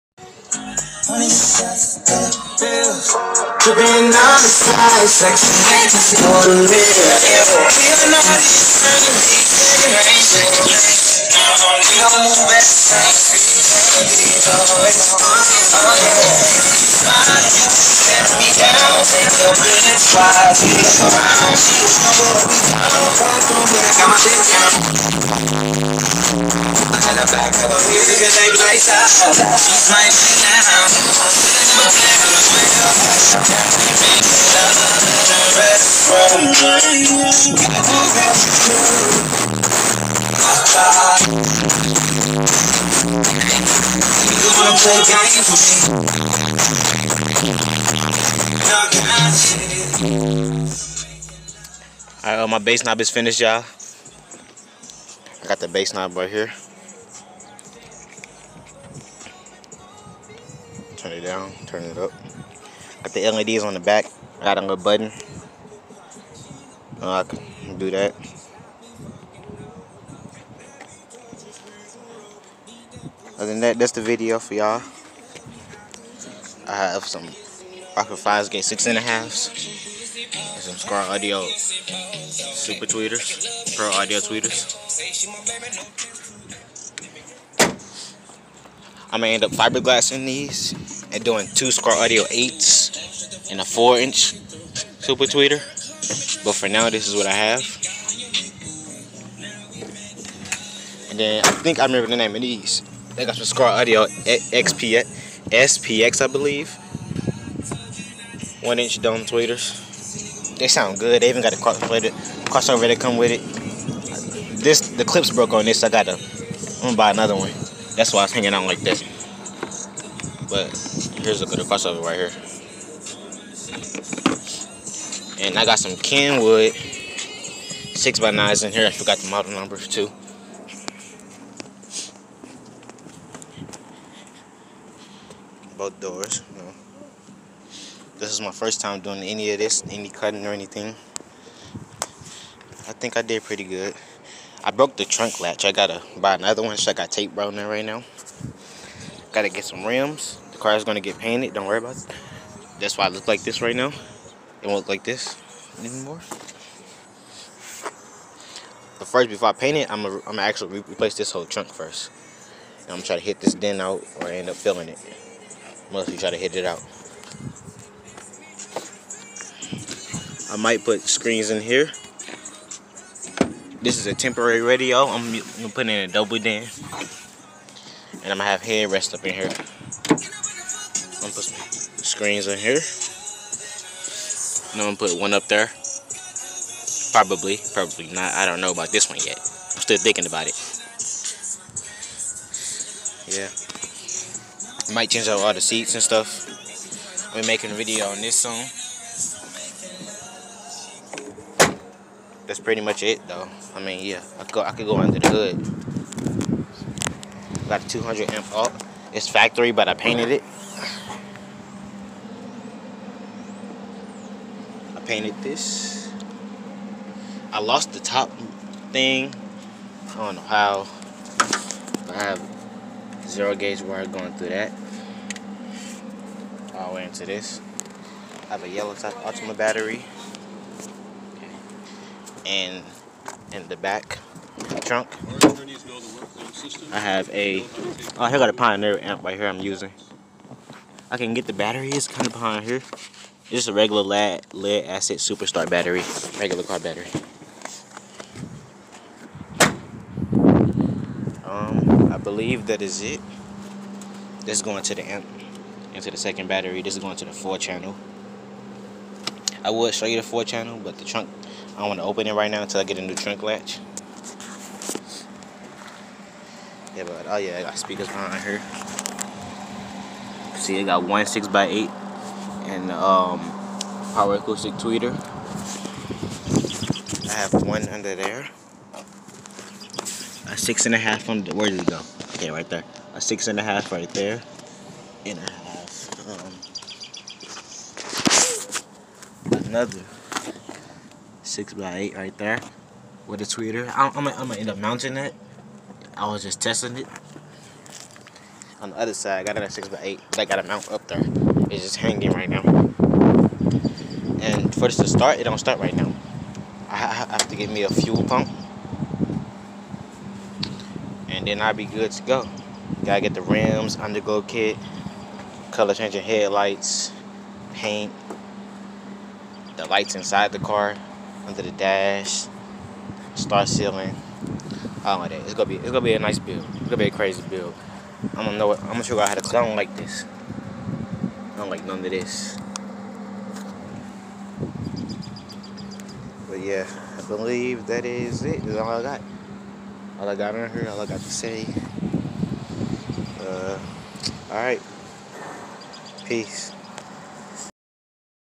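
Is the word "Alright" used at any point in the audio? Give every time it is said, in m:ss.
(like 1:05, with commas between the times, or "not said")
0:52, 5:44.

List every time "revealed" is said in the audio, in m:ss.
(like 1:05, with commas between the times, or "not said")
not said.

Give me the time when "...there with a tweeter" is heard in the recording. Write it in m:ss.
4:52.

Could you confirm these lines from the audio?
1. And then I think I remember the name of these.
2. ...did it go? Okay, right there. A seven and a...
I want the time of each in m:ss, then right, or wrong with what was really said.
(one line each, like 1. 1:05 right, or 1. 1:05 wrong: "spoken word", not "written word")
1. 1:41 right
2. 4:41 wrong: "six", not "seven".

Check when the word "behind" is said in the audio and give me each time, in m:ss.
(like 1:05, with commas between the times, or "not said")
4:02, 4:28.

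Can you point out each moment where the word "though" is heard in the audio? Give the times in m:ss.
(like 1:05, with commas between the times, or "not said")
3:23.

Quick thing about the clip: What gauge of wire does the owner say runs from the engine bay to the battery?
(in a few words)
zero gauge.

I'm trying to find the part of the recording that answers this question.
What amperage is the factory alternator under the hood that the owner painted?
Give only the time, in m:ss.
3:27.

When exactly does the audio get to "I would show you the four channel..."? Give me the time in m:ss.
4:19.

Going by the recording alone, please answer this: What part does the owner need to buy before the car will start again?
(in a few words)
fuel pump.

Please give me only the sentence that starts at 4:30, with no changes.
See, it got one six by eight and um, Power Acoustik Tweeter.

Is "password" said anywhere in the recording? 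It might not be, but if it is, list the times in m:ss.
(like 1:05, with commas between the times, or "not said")
not said.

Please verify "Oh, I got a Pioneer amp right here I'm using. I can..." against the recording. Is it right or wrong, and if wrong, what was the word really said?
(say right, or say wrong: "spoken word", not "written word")
right.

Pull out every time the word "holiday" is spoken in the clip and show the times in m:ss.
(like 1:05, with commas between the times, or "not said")
not said.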